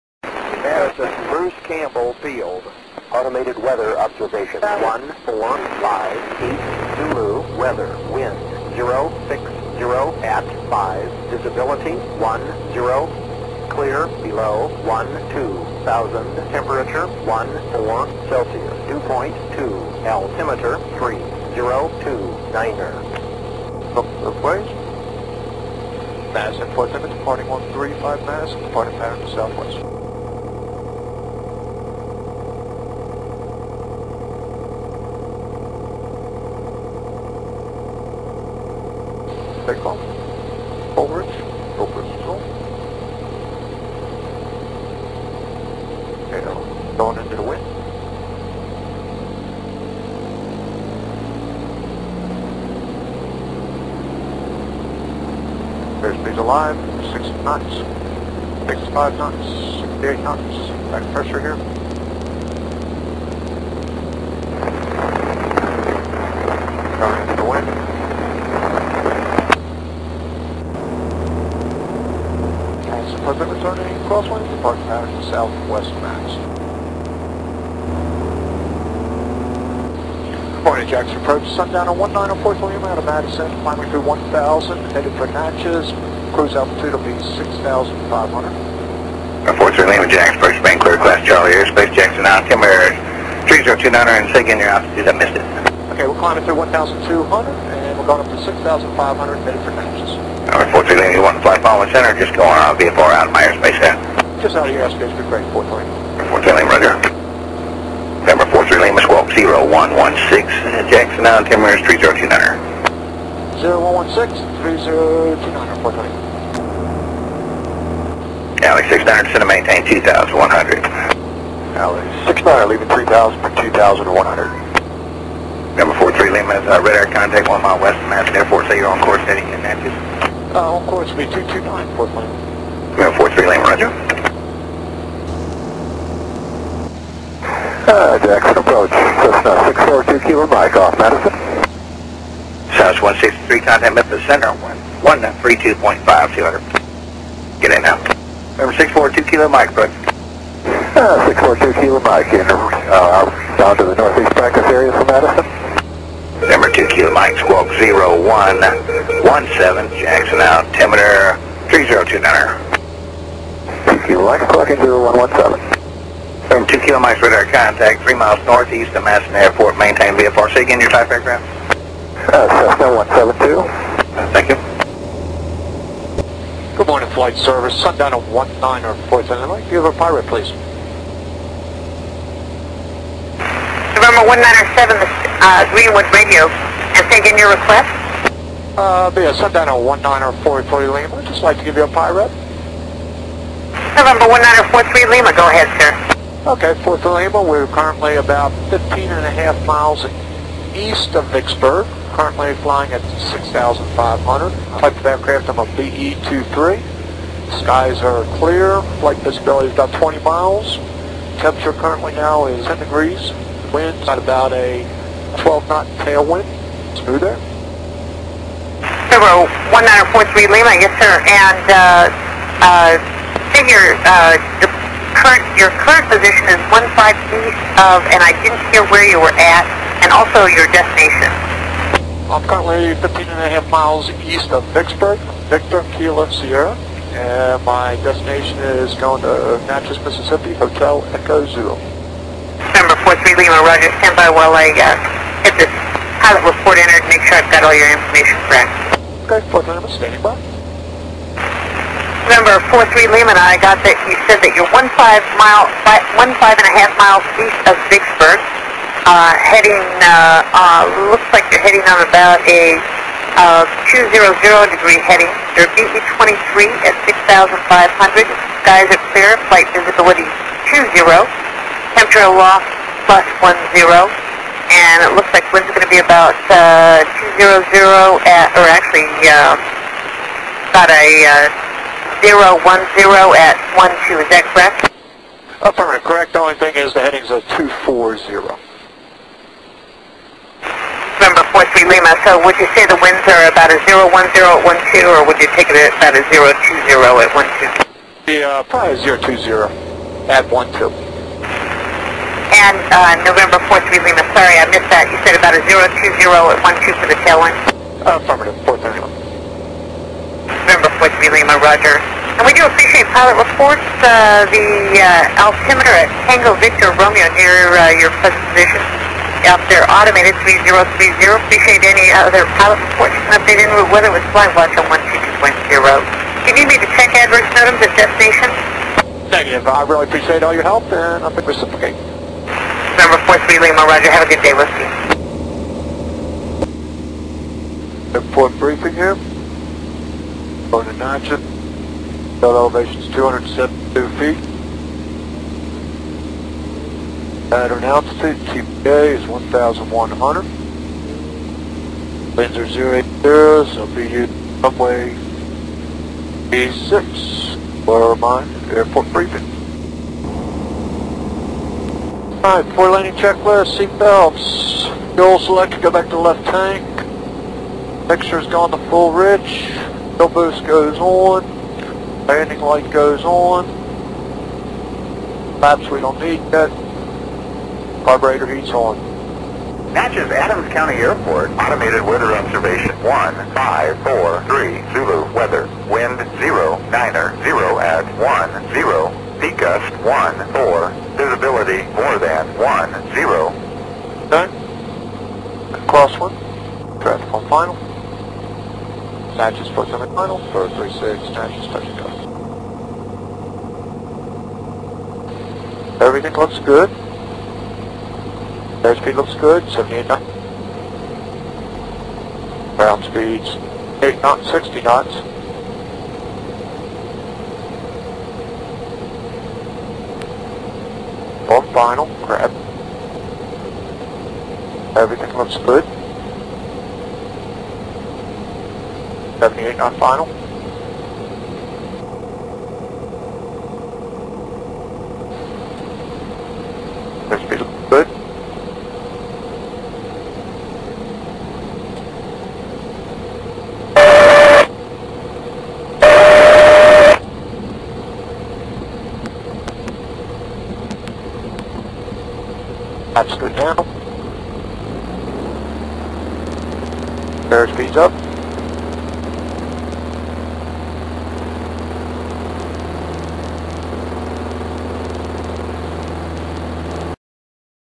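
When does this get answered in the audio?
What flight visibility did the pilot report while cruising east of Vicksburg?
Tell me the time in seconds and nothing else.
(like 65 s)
209 s.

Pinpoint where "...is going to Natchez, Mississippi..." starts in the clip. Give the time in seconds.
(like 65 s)
238 s.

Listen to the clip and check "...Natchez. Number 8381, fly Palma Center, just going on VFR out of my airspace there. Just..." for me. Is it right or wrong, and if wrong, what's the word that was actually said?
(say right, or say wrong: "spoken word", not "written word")
wrong: "4381", not "8381".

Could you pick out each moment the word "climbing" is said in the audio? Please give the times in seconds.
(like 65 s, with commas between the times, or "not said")
83 s, 96 s.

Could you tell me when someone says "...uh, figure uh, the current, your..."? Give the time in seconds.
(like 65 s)
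222 s.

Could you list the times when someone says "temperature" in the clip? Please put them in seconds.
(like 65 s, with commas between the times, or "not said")
16 s, 211 s, 271 s.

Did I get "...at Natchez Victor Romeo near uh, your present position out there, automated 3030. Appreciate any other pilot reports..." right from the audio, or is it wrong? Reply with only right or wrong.
wrong.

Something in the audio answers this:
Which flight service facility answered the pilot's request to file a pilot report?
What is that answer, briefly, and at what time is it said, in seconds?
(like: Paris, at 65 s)
Greenwood Radio, at 185 s.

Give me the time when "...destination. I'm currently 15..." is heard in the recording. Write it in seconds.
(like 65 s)
230 s.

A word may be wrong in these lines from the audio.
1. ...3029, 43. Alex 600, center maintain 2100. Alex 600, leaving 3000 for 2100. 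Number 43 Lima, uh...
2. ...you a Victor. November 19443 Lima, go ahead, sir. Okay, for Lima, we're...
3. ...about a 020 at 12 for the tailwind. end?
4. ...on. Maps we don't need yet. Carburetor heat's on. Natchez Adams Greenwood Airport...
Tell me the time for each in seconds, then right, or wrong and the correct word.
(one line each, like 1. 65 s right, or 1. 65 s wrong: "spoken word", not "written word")
1. 115 s right
2. 191 s wrong: "PIREP", not "Victor"
3. 305 s right
4. 373 s wrong: "County", not "Greenwood".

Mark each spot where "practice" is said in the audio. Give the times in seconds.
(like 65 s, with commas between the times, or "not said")
154 s.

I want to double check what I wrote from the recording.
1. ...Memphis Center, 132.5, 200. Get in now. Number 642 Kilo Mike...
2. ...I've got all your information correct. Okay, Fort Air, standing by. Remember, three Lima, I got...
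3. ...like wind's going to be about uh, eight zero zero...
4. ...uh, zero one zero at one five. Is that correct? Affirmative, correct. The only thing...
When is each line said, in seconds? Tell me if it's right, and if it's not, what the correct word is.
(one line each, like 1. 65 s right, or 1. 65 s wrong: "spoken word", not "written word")
1. 143 s right
2. 247 s wrong: "Lima", not "Air"
3. 275 s wrong: "two", not "eight"
4. 281 s wrong: "two", not "five".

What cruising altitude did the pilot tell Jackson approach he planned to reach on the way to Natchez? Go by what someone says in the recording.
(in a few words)
6500.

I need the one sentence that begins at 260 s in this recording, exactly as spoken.
Uh, uh, looks like you're heading on about a uh, 200 degree heading.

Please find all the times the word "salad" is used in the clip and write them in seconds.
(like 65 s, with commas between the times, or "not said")
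not said.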